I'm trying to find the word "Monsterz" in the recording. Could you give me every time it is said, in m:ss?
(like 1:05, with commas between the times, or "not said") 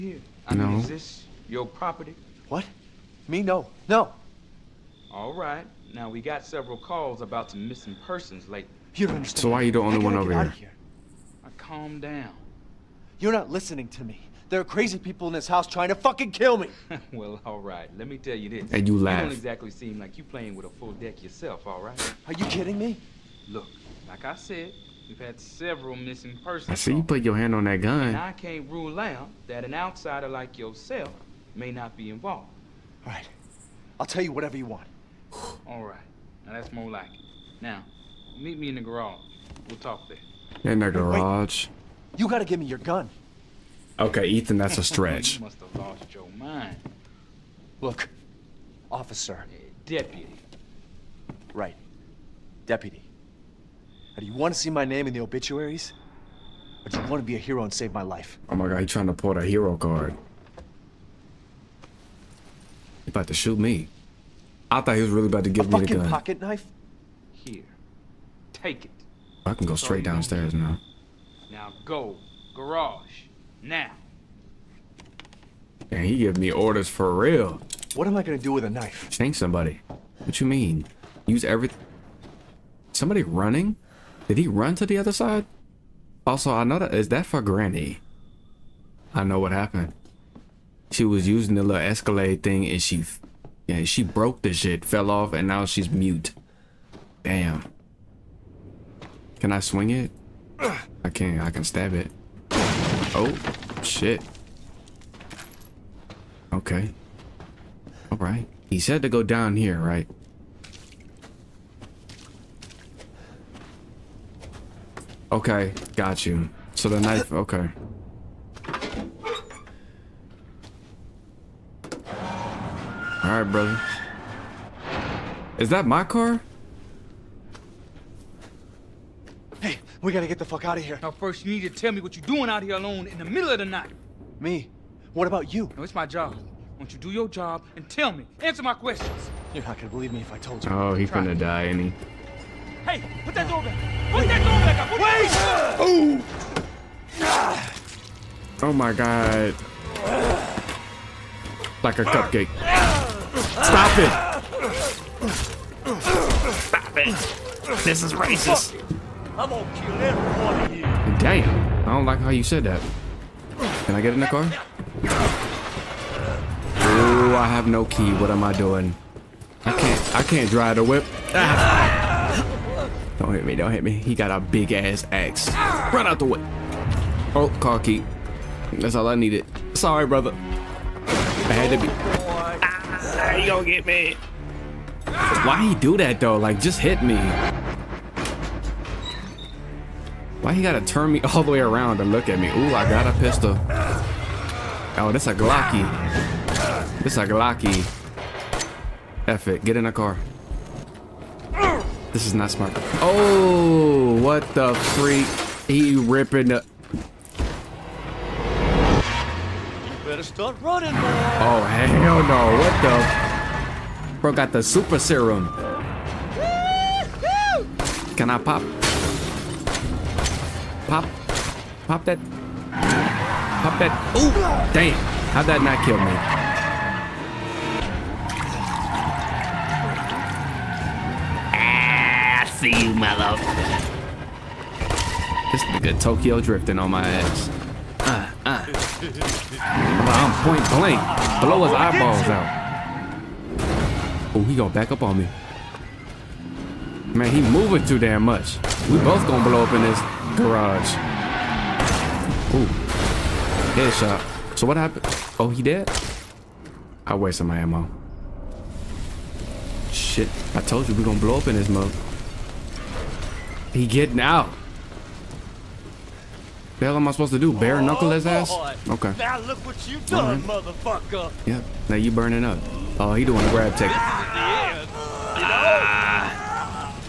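not said.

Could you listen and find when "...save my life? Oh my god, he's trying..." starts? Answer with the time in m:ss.
0:57.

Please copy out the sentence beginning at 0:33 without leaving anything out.
I'll tell you whatever you want.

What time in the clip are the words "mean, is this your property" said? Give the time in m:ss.
0:00.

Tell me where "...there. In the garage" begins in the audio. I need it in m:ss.
0:40.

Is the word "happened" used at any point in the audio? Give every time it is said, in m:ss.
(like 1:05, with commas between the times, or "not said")
1:29, 4:14.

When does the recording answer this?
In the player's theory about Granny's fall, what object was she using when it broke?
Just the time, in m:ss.
1:31.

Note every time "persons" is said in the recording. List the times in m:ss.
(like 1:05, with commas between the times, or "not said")
0:08, 0:26.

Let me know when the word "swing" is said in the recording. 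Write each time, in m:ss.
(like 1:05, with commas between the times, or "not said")
1:39.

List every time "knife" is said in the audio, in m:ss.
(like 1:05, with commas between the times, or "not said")
1:06, 1:18, 1:56.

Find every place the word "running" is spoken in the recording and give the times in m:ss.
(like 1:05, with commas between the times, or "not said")
1:23, 3:30.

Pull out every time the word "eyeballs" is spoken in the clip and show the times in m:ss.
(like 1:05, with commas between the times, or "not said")
4:01.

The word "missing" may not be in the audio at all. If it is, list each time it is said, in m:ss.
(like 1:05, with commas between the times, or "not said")
0:07, 0:25.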